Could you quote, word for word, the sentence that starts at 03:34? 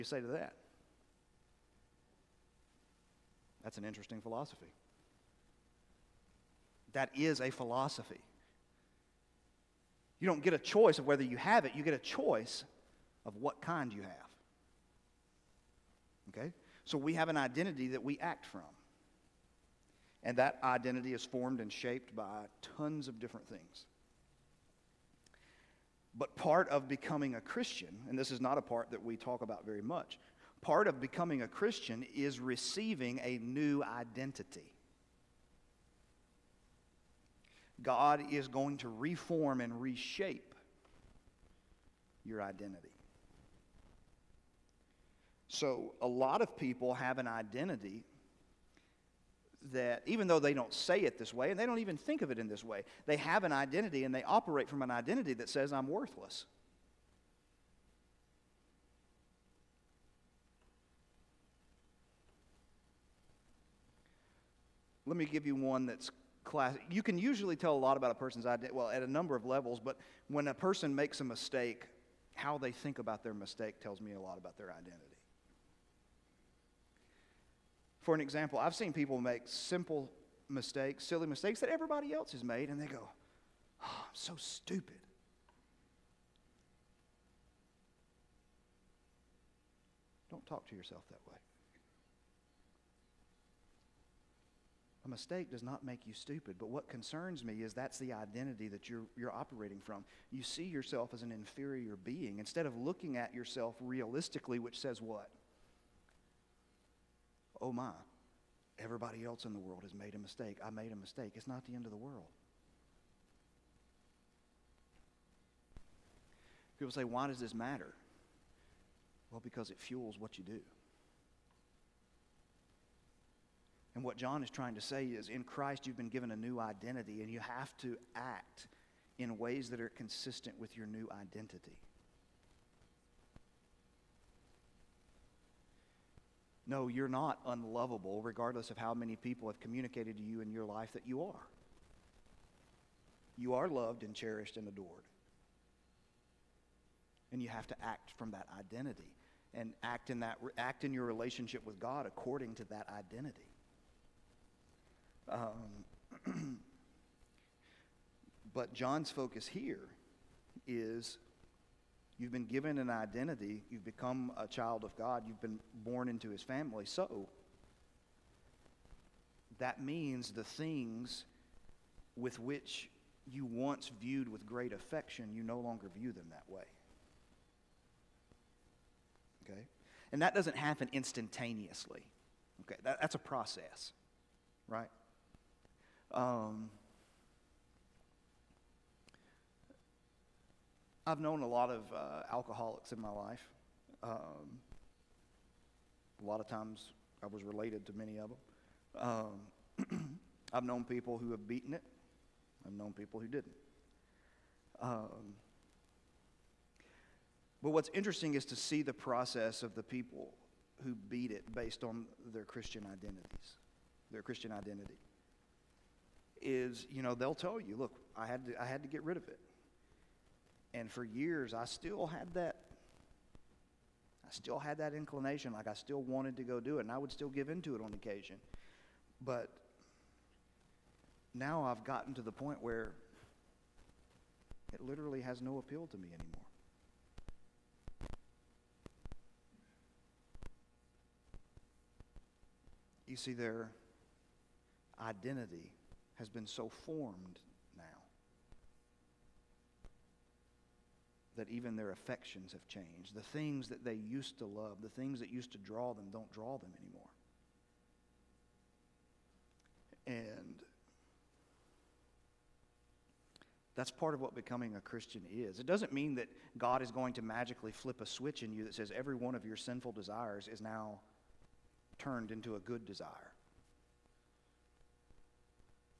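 Their Christian identity is, you know, they'll tell you, look, I had to, I had to get rid of it.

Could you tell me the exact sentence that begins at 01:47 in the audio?
oh my, everybody else in the world has made a mistake.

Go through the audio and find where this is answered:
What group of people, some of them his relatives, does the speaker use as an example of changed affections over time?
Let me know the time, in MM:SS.
03:12.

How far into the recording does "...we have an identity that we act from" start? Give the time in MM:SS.
00:16.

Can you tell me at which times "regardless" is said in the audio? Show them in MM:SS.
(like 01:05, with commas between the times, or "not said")
02:18.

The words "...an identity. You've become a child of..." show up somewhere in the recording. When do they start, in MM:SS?
02:42.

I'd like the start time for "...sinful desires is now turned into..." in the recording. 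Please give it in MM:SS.
04:29.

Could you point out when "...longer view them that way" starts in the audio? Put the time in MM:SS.
02:55.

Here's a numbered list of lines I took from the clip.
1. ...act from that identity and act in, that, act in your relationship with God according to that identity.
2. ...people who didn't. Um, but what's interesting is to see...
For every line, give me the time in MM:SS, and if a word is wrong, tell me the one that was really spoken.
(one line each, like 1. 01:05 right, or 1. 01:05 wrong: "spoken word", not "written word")
1. 02:27 right
2. 03:22 right.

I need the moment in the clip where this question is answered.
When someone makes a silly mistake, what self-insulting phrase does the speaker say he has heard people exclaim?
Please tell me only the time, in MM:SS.
01:23.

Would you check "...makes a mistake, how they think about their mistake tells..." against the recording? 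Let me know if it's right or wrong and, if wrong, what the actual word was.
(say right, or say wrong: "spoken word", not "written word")
right.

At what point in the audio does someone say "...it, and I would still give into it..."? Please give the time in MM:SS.
03:46.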